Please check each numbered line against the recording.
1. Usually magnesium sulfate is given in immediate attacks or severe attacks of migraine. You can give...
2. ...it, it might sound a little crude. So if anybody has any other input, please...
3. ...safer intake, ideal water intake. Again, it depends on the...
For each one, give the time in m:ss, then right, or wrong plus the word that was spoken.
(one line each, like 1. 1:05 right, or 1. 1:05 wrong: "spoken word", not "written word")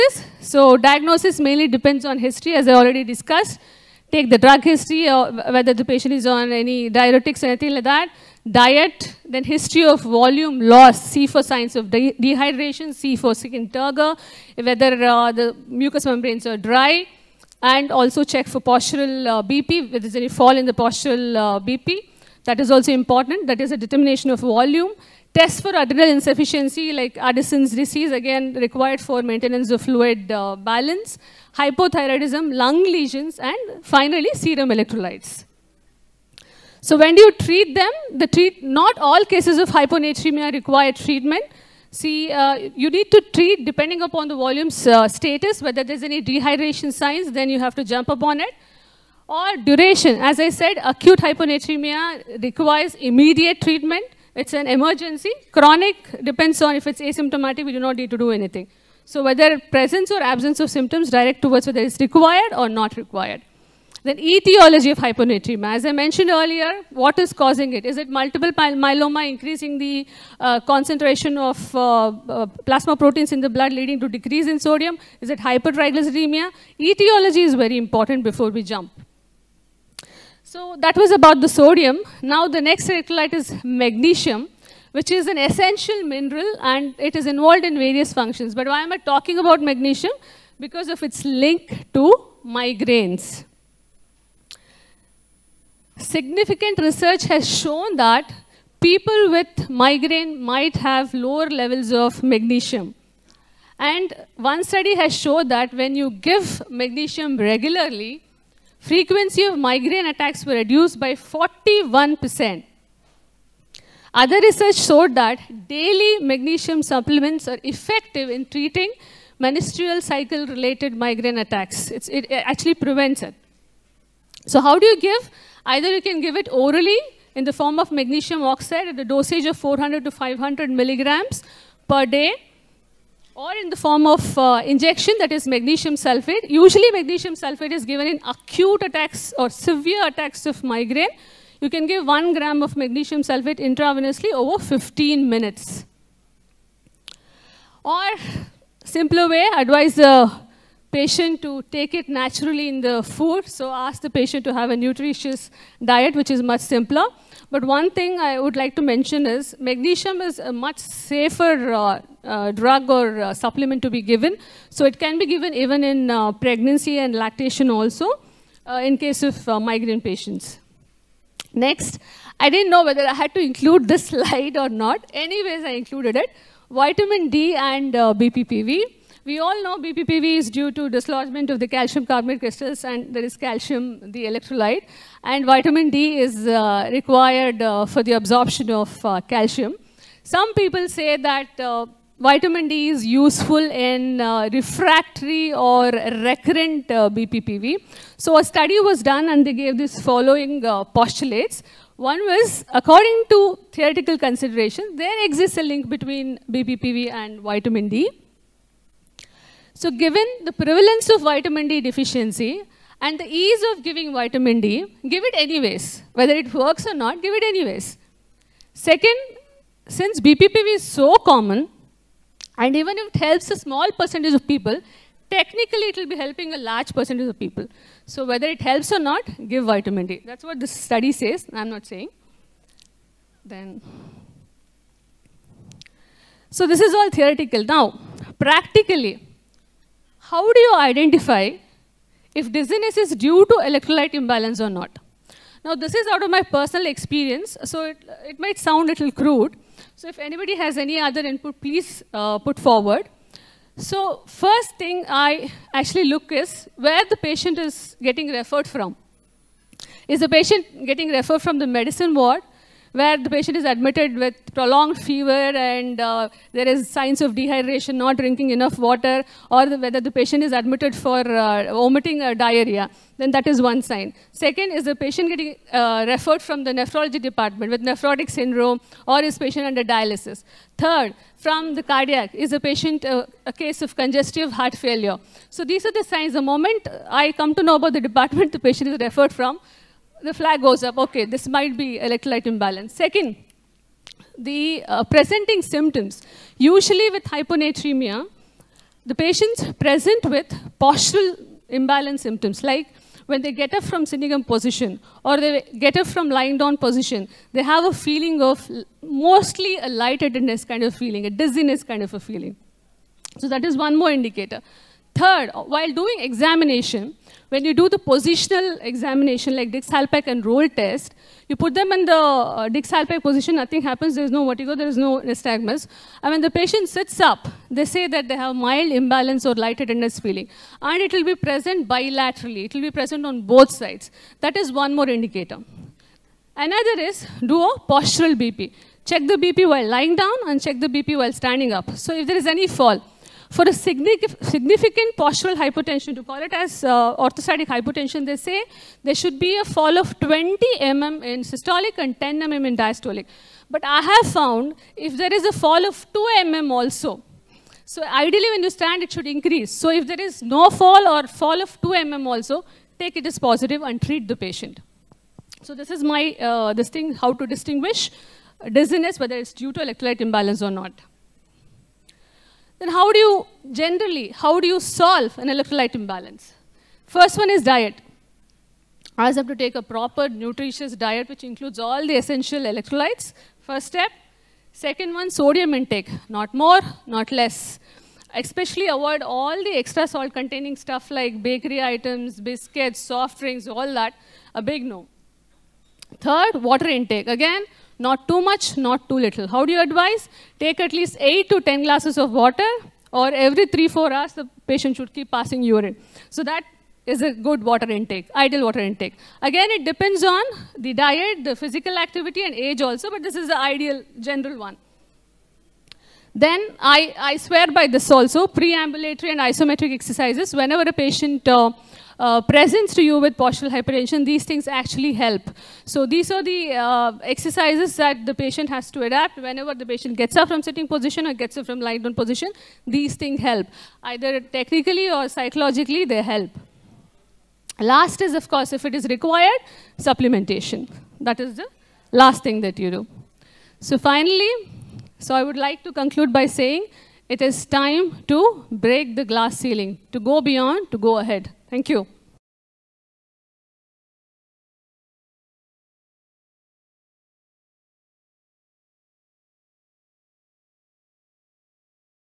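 1. 2:16 wrong: "acute", not "immediate"
2. 4:07 right
3. 6:47 wrong: "water", not "safer".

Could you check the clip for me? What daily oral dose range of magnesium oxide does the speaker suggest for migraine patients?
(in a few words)
400 to 500 mg.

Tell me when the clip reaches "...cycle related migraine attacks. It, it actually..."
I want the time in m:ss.
2:00.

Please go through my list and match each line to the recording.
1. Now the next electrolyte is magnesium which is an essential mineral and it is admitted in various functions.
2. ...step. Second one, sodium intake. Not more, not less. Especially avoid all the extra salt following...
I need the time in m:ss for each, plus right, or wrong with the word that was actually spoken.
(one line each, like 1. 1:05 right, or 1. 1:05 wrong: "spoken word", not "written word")
1. 1:22 wrong: "involved", not "admitted"
2. 6:23 wrong: "containing", not "following".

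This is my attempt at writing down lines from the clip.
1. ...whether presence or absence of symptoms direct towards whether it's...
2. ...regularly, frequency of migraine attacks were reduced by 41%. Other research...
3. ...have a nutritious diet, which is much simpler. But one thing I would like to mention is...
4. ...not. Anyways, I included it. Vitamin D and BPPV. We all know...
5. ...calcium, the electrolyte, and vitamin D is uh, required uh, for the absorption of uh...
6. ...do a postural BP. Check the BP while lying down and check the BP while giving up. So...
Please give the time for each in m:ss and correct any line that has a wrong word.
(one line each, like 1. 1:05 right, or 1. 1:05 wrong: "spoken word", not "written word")
1. 0:59 right
2. 1:47 right
3. 2:34 right
4. 2:54 right
5. 3:03 right
6. 5:37 wrong: "standing", not "giving".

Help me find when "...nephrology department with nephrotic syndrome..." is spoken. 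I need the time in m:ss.
4:36.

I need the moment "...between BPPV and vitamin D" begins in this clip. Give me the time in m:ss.
3:25.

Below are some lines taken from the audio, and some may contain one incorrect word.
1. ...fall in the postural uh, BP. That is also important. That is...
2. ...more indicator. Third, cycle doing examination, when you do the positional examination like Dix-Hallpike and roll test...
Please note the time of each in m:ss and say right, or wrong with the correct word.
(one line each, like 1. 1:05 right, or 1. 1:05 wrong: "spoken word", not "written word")
1. 0:20 right
2. 5:13 wrong: "while", not "cycle".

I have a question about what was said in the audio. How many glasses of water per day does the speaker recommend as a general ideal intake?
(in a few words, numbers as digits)
8 to 10.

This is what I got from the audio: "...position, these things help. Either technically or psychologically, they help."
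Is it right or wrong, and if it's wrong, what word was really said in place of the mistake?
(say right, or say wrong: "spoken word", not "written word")
right.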